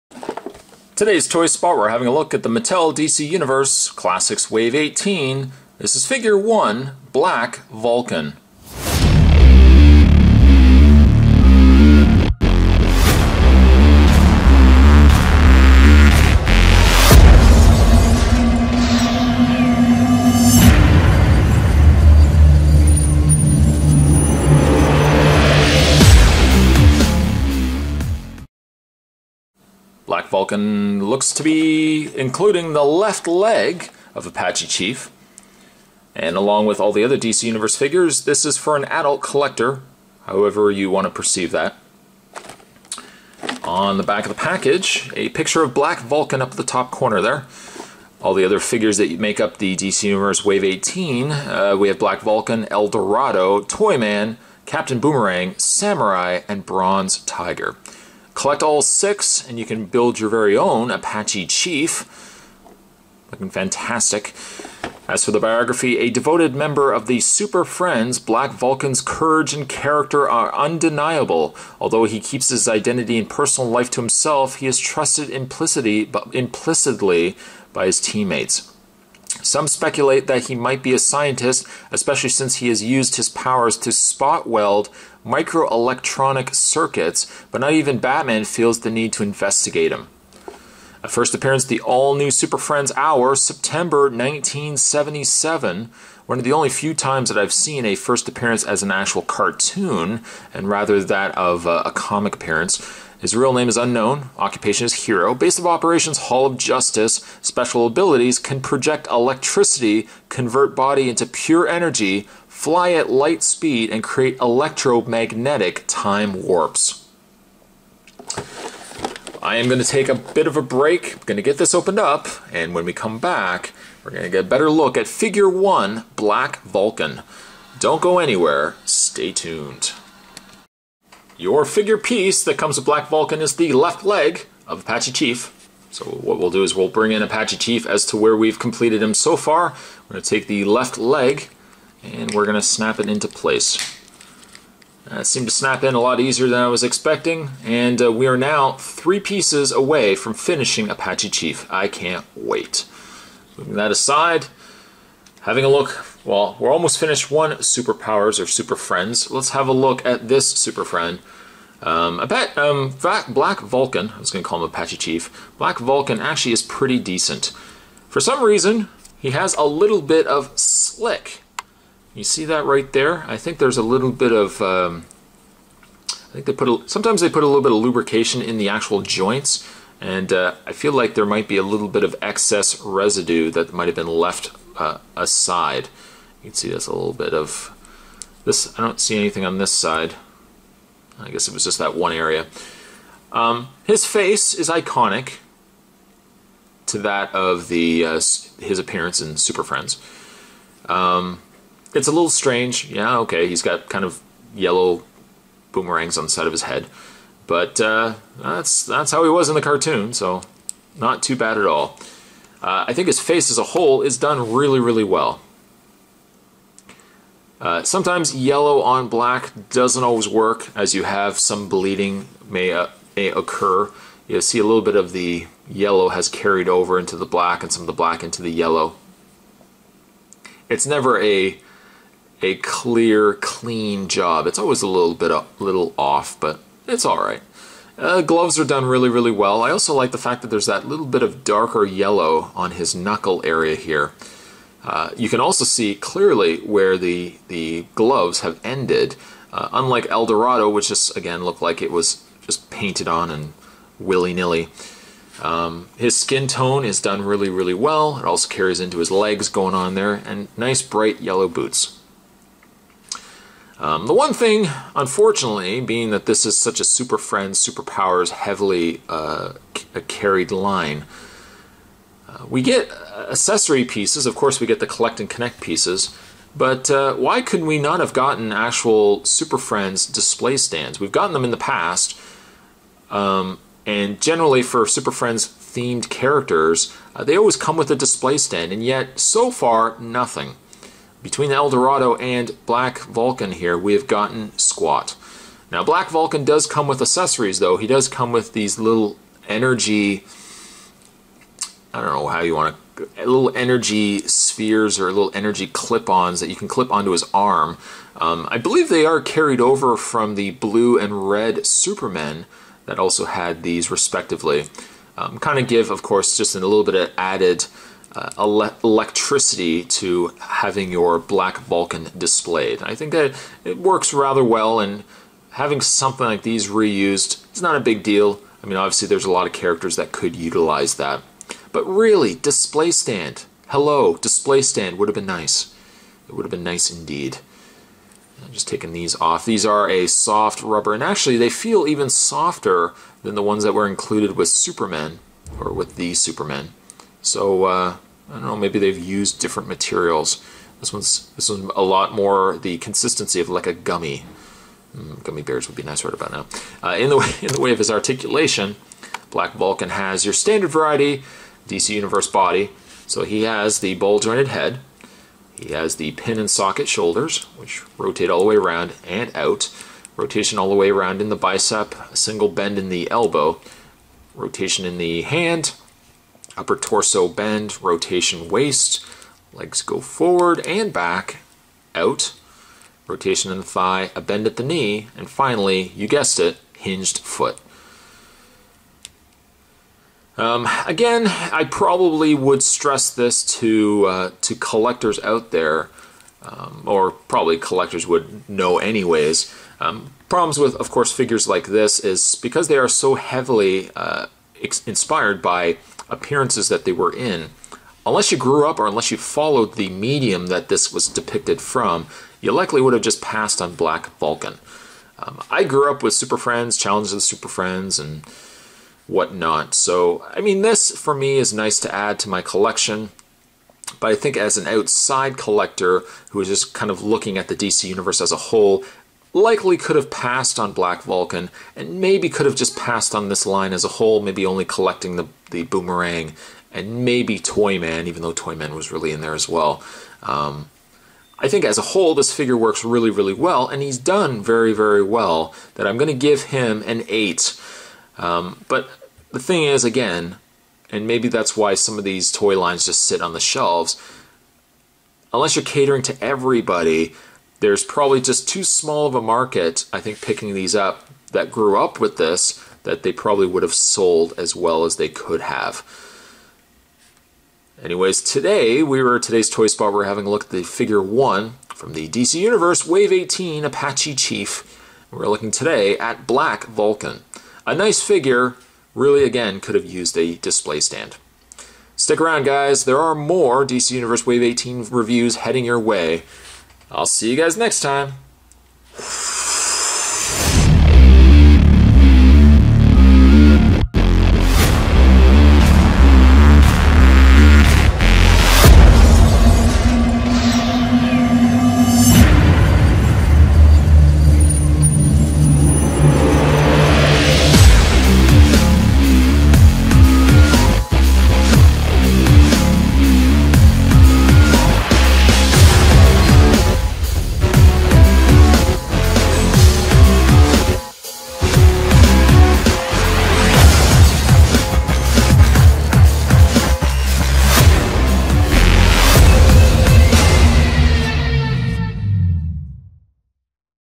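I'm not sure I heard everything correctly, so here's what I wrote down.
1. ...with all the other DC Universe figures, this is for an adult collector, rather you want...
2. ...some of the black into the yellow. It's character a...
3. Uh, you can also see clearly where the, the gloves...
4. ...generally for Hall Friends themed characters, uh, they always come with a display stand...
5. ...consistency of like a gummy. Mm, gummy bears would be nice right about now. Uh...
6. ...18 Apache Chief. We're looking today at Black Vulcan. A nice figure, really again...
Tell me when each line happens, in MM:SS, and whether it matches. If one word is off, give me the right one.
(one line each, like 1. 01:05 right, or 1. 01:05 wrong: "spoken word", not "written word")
1. 00:36 wrong: "however", not "rather"
2. 03:47 wrong: "never", not "character"
3. 04:04 right
4. 04:44 wrong: "Super", not "Hall"
5. 05:52 right
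6. 07:53 right.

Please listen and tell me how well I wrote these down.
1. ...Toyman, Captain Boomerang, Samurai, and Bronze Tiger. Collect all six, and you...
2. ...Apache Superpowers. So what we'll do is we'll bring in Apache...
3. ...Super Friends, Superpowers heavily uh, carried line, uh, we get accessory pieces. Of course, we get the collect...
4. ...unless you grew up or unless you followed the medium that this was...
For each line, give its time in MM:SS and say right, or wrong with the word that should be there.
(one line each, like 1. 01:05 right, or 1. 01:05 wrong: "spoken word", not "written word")
1. 00:53 right
2. 02:14 wrong: "Chief", not "Superpowers"
3. 04:26 right
4. 06:48 right.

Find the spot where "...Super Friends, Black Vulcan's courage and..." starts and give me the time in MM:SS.
01:07.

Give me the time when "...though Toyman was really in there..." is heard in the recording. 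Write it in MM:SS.
07:18.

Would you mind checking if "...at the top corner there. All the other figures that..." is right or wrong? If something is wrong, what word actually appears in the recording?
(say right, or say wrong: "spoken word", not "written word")
right.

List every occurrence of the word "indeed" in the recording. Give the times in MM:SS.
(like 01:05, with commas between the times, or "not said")
05:36.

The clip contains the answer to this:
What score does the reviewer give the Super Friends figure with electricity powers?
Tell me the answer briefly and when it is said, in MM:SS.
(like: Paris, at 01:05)
8, at 07:27.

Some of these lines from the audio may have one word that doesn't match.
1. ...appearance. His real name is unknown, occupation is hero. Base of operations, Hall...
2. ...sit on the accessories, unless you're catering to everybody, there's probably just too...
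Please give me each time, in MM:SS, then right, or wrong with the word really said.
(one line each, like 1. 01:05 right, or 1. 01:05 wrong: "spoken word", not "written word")
1. 01:42 right
2. 07:33 wrong: "shelves", not "accessories".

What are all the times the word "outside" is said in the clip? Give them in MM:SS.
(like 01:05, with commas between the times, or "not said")
07:04.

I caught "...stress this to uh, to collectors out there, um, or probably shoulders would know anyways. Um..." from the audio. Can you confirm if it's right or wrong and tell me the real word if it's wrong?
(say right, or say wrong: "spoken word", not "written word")
wrong: "collectors", not "shoulders".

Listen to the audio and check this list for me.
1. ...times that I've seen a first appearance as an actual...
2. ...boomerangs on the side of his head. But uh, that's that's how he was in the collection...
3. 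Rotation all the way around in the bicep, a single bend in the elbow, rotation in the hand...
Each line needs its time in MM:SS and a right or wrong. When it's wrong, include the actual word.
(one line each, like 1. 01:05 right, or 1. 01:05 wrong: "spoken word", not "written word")
1. 01:36 right
2. 03:25 wrong: "cartoon", not "collection"
3. 06:10 right.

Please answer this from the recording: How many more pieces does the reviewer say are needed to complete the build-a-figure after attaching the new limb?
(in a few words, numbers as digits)
3.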